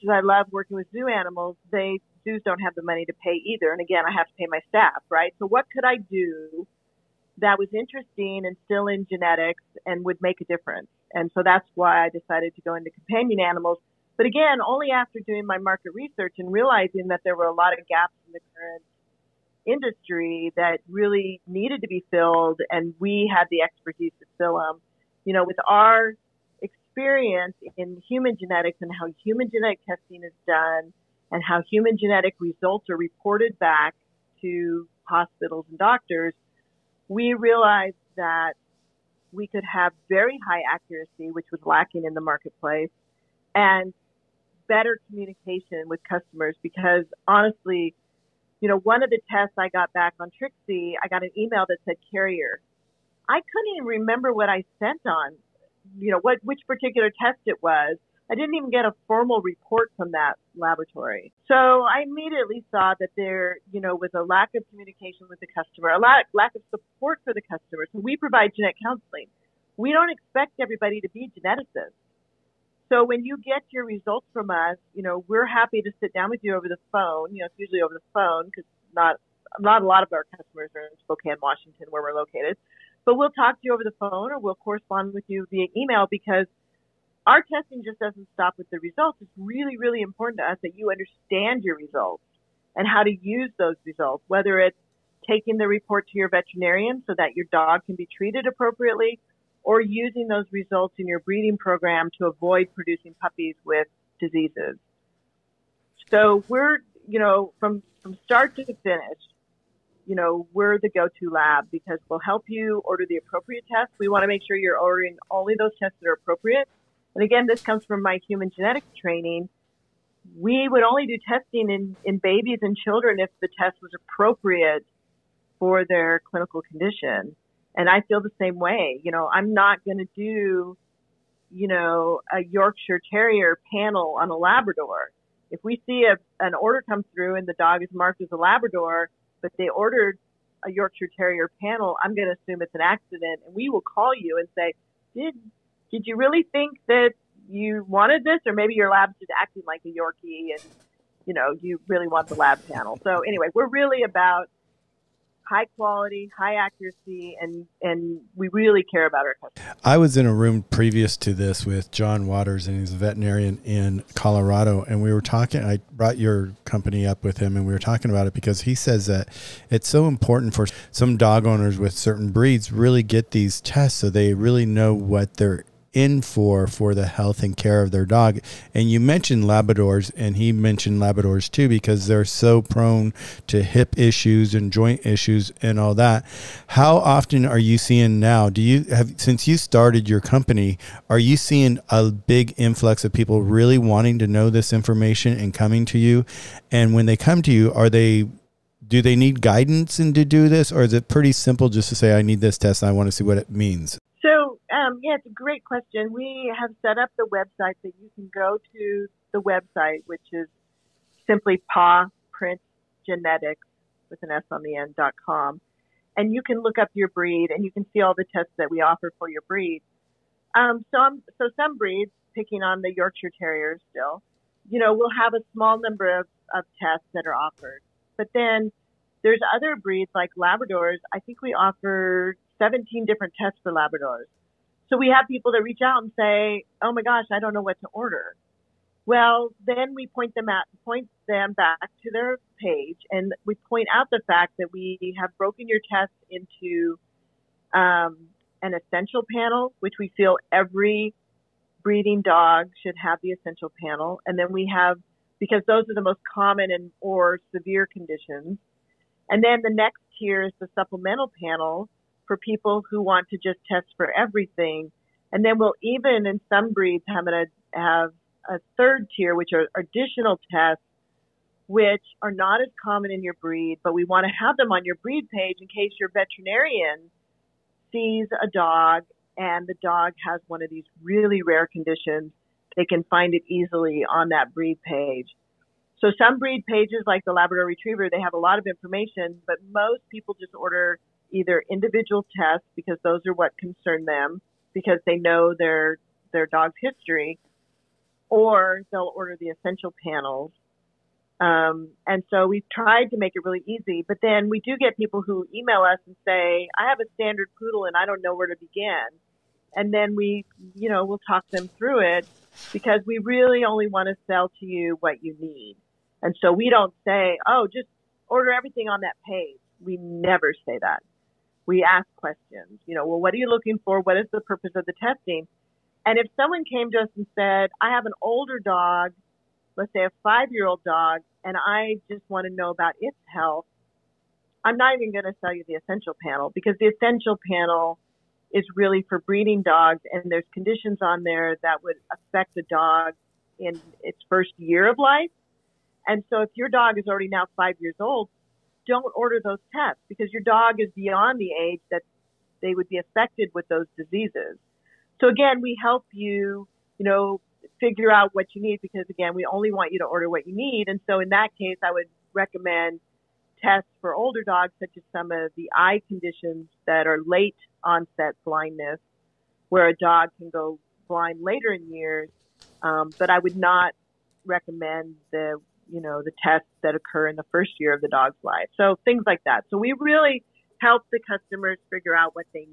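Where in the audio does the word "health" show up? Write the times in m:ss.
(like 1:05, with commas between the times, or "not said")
2:57, 5:33.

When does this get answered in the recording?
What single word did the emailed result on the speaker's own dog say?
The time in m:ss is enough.
0:52.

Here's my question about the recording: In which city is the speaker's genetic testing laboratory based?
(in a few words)
Spokane, Washington.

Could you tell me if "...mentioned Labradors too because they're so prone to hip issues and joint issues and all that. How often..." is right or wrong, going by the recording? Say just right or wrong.
right.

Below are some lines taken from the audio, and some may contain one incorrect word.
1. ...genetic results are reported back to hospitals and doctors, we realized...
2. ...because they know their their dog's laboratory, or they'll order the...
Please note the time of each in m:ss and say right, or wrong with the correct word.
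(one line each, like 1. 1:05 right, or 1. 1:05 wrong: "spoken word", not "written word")
1. 0:31 right
2. 4:54 wrong: "history", not "laboratory".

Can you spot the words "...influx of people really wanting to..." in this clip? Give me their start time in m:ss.
3:12.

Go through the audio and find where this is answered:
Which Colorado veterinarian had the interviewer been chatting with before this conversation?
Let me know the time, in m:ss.
2:41.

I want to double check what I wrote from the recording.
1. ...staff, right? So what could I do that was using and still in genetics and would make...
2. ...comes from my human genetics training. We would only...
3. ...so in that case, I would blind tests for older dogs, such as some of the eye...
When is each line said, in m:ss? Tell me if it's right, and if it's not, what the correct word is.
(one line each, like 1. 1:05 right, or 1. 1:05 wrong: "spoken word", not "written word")
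1. 0:04 wrong: "interesting", not "using"
2. 1:57 right
3. 6:01 wrong: "recommend", not "blind".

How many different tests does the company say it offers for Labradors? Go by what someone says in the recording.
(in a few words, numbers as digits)
17.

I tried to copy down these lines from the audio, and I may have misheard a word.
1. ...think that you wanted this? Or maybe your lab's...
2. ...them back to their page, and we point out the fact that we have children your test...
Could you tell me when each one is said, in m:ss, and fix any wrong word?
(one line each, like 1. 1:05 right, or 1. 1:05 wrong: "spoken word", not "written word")
1. 2:26 right
2. 4:01 wrong: "broken", not "children".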